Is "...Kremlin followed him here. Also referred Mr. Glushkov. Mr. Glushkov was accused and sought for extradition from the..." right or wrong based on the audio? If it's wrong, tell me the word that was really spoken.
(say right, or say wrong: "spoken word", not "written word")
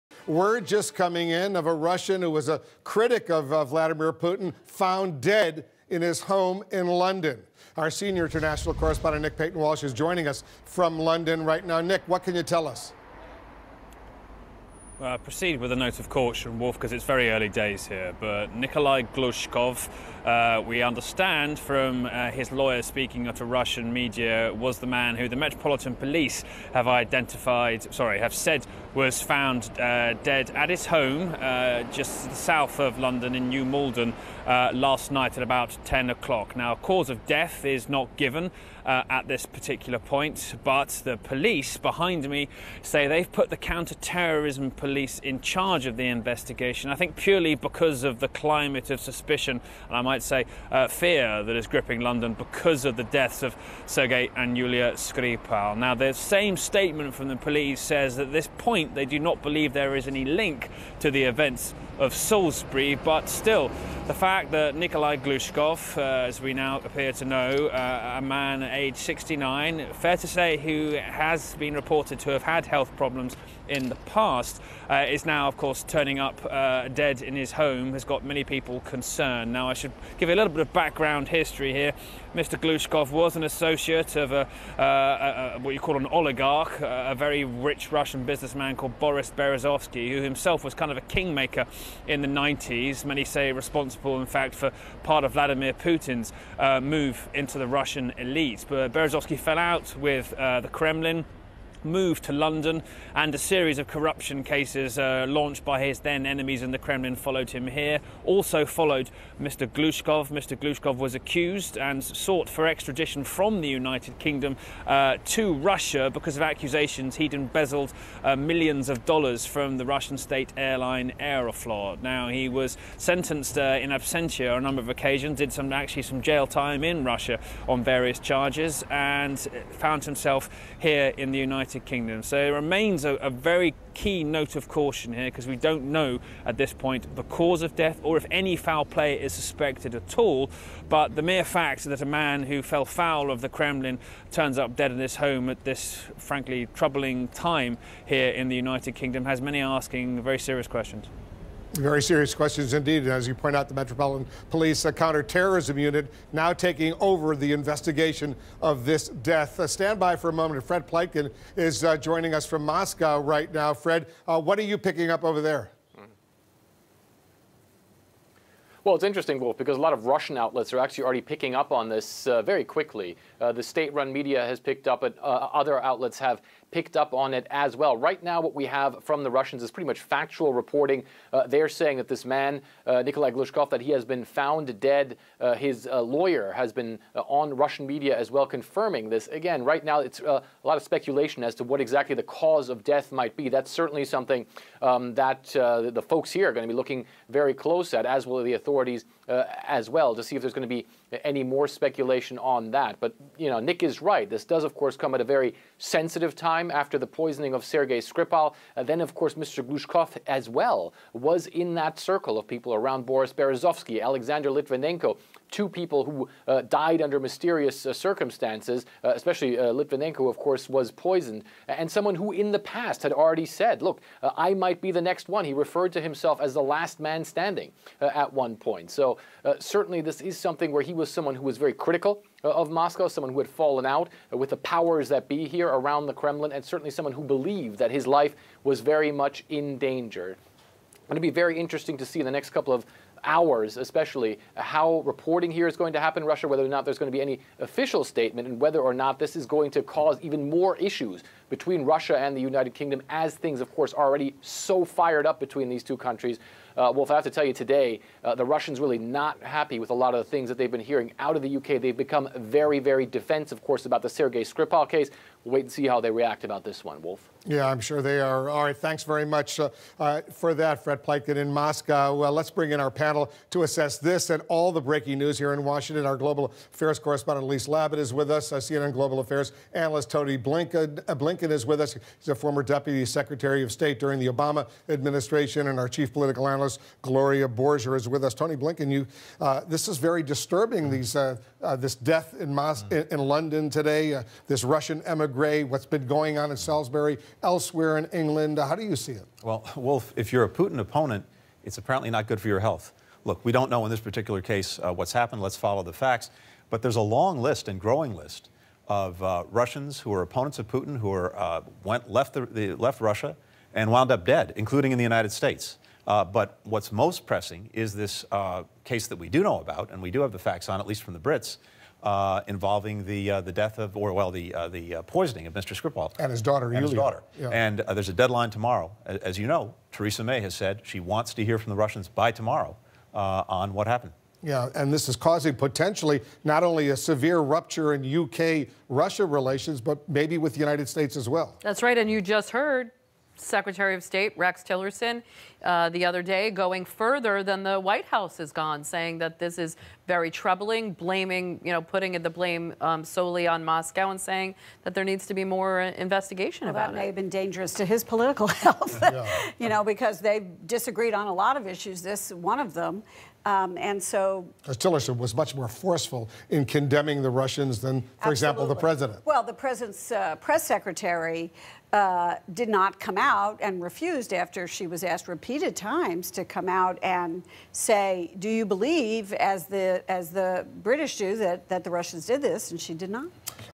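wrong: "followed", not "referred".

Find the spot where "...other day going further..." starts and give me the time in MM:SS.
05:46.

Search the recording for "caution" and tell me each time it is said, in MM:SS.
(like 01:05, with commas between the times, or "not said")
00:16, 02:14.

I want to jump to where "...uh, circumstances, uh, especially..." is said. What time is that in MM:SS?
03:37.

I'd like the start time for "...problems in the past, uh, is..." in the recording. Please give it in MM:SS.
01:12.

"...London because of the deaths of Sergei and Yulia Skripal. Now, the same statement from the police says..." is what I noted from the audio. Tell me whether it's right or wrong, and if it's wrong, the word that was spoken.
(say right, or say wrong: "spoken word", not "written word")
right.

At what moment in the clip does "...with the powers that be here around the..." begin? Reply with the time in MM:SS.
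03:54.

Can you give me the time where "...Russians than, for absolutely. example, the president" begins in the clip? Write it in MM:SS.
06:07.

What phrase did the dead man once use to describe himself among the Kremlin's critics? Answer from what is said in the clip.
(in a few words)
the last man standing.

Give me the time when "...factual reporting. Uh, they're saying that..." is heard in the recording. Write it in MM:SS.
02:59.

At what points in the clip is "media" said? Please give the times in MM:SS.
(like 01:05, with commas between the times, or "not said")
00:23, 02:54, 03:07.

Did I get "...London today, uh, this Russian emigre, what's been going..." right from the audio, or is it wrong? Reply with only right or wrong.
right.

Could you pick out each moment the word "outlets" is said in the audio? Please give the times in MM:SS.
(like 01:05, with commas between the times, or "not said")
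02:50, 02:55.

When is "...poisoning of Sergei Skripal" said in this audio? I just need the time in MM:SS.
03:27.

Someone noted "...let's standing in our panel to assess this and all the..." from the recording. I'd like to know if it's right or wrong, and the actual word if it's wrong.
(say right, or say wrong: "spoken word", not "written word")
wrong: "bring", not "standing".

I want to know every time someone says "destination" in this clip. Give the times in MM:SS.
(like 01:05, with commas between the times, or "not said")
not said.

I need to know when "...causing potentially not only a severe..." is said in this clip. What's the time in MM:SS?
05:35.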